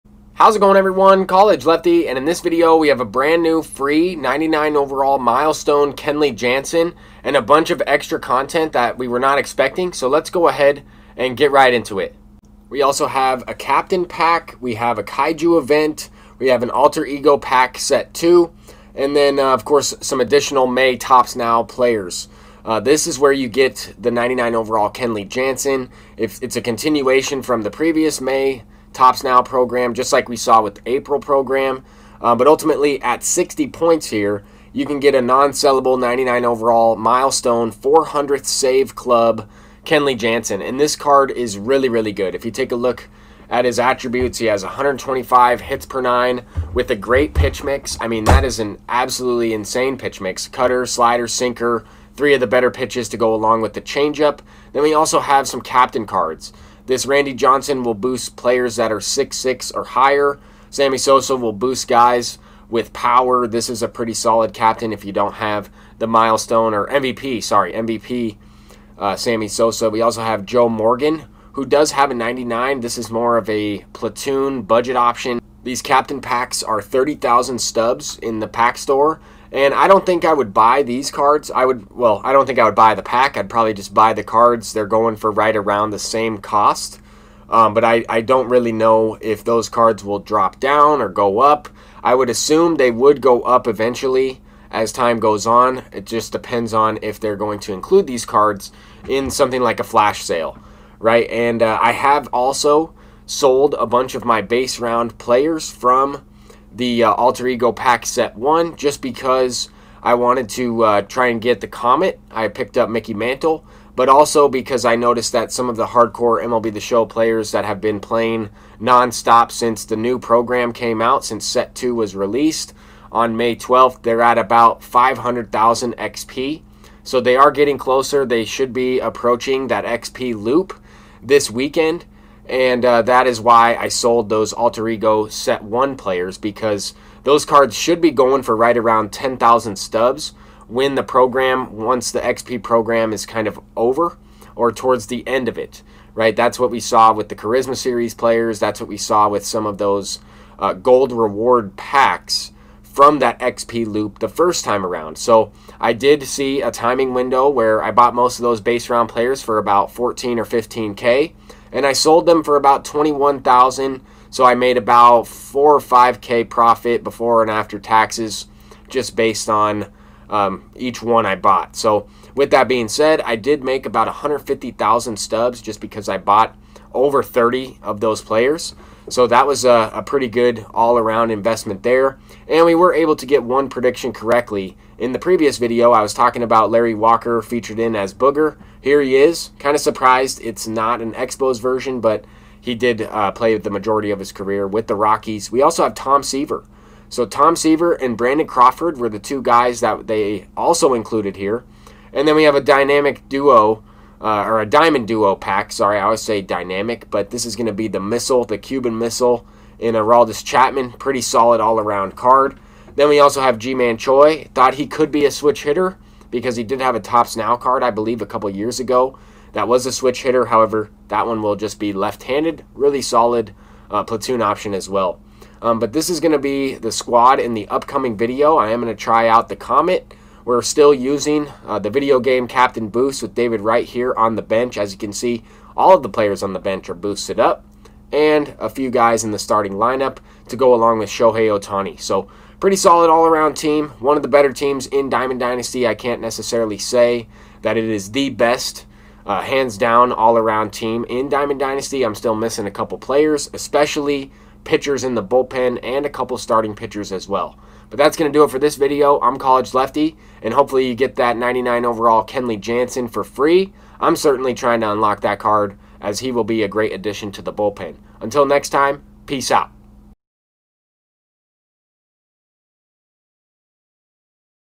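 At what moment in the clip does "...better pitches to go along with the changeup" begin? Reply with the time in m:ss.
0:52.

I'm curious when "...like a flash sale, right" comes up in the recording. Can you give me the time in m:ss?
1:39.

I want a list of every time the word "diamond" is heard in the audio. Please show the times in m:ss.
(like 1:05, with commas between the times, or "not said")
3:24, 4:05, 4:11.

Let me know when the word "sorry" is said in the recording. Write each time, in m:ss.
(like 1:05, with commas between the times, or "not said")
1:07, 3:25.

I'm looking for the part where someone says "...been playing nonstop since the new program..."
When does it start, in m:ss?
1:57.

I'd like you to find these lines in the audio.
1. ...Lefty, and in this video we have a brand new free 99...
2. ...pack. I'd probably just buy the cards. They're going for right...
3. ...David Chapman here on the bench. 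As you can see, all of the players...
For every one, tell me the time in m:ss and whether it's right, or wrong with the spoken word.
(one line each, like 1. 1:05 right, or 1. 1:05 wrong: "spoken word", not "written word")
1. 0:01 right
2. 1:23 right
3. 3:53 wrong: "Wright", not "Chapman".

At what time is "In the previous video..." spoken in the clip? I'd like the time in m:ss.
3:04.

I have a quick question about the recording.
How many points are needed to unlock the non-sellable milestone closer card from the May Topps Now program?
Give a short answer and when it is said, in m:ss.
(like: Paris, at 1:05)
60, at 0:33.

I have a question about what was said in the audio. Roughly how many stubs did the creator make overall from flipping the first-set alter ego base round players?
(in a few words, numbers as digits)
150,000.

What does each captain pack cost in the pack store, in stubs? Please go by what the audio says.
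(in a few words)
30,000.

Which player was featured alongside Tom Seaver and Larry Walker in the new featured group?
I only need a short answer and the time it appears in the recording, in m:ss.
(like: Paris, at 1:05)
Brandon Crawford, at 3:18.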